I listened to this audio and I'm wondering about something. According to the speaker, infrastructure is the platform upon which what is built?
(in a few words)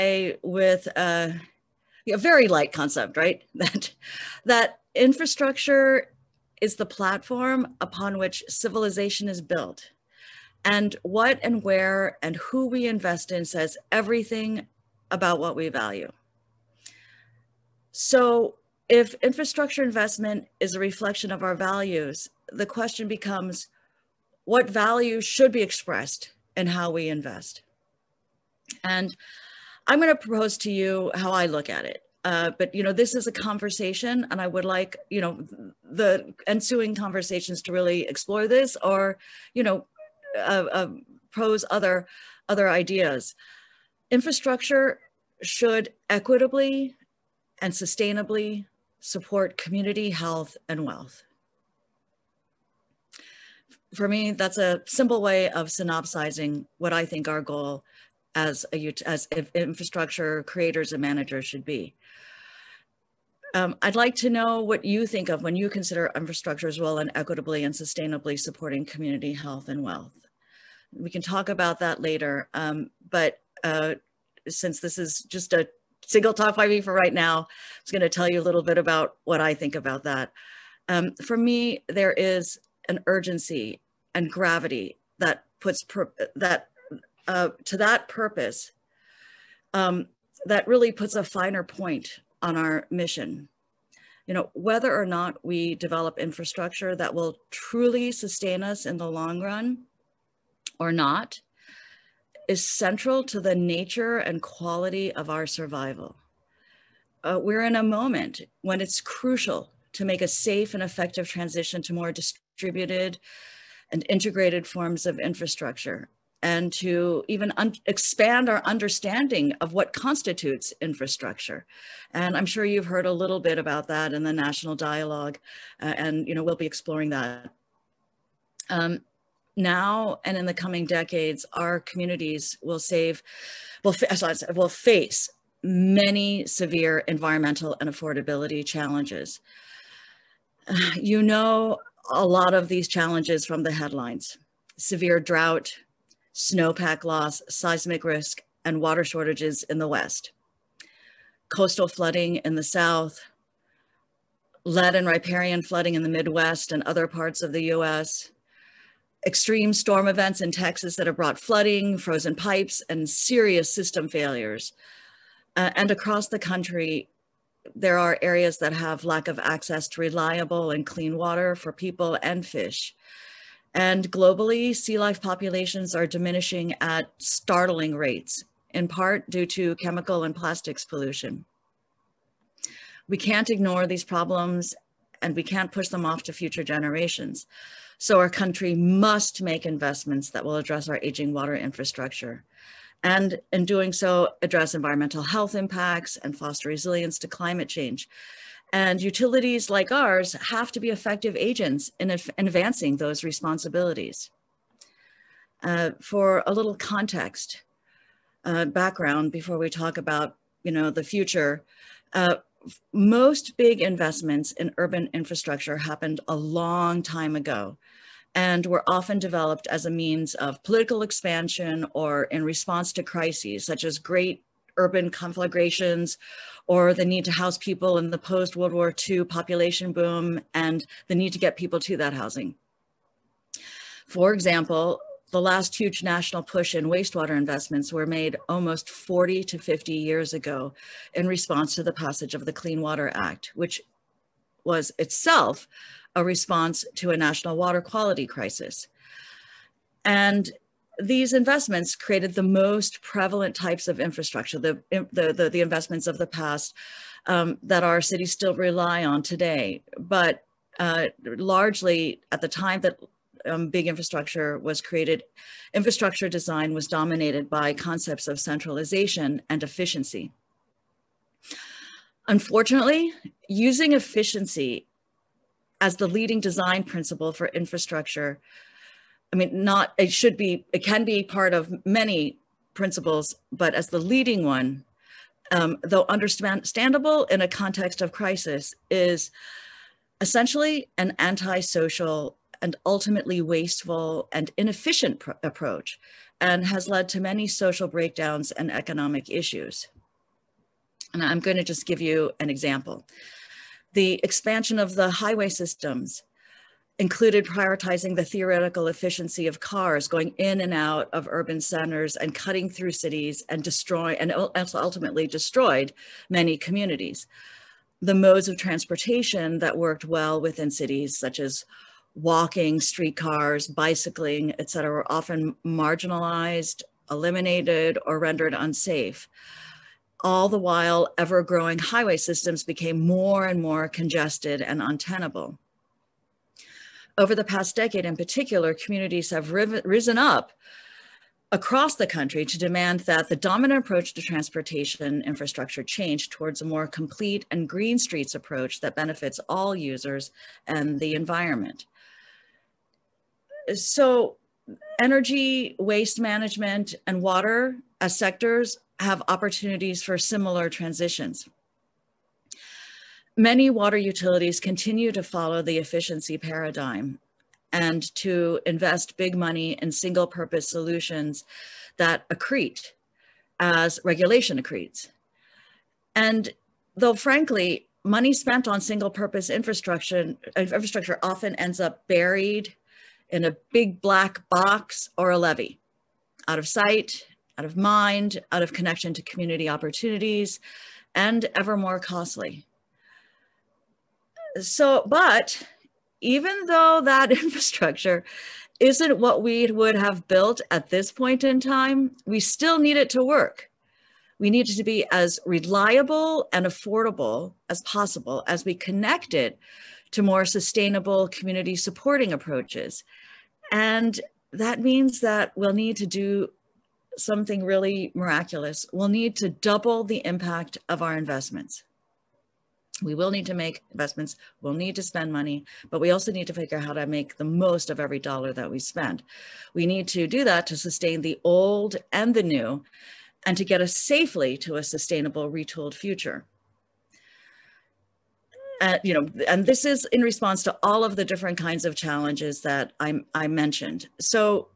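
civilization.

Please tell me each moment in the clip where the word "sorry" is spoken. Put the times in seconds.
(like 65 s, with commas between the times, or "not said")
133 s.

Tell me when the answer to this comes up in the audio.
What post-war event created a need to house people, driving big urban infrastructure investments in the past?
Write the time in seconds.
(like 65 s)
229 s.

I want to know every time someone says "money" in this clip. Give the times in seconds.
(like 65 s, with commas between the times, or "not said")
369 s, 378 s, 425 s.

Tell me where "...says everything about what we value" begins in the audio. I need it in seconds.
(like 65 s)
13 s.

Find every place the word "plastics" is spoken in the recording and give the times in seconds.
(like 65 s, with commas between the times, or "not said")
180 s.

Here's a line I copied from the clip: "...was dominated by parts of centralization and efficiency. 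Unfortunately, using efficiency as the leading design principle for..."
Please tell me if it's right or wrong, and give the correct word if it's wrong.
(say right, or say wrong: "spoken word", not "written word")
wrong: "concepts", not "parts".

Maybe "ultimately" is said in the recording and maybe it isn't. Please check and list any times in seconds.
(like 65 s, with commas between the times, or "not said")
292 s, 314 s.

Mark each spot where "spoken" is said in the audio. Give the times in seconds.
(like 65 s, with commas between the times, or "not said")
not said.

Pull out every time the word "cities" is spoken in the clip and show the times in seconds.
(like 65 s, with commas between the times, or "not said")
258 s, 312 s, 320 s.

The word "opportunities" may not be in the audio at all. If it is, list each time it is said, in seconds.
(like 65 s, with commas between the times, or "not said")
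359 s, 389 s.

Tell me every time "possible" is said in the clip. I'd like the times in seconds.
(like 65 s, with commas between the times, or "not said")
407 s.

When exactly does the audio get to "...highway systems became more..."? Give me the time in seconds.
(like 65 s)
331 s.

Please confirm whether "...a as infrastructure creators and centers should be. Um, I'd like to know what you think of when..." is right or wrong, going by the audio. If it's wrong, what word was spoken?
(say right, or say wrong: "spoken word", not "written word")
wrong: "managers", not "centers".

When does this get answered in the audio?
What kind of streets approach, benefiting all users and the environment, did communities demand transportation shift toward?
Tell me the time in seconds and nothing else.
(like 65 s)
346 s.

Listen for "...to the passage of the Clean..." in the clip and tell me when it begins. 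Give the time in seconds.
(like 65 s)
241 s.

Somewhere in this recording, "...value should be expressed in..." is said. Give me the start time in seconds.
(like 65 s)
24 s.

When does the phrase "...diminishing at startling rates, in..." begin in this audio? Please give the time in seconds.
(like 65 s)
176 s.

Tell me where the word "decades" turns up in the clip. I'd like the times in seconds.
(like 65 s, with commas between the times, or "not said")
130 s, 337 s.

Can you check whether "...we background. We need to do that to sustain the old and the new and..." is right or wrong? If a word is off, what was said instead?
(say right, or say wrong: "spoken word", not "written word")
wrong: "spend", not "background".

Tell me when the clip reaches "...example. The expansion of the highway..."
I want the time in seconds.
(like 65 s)
302 s.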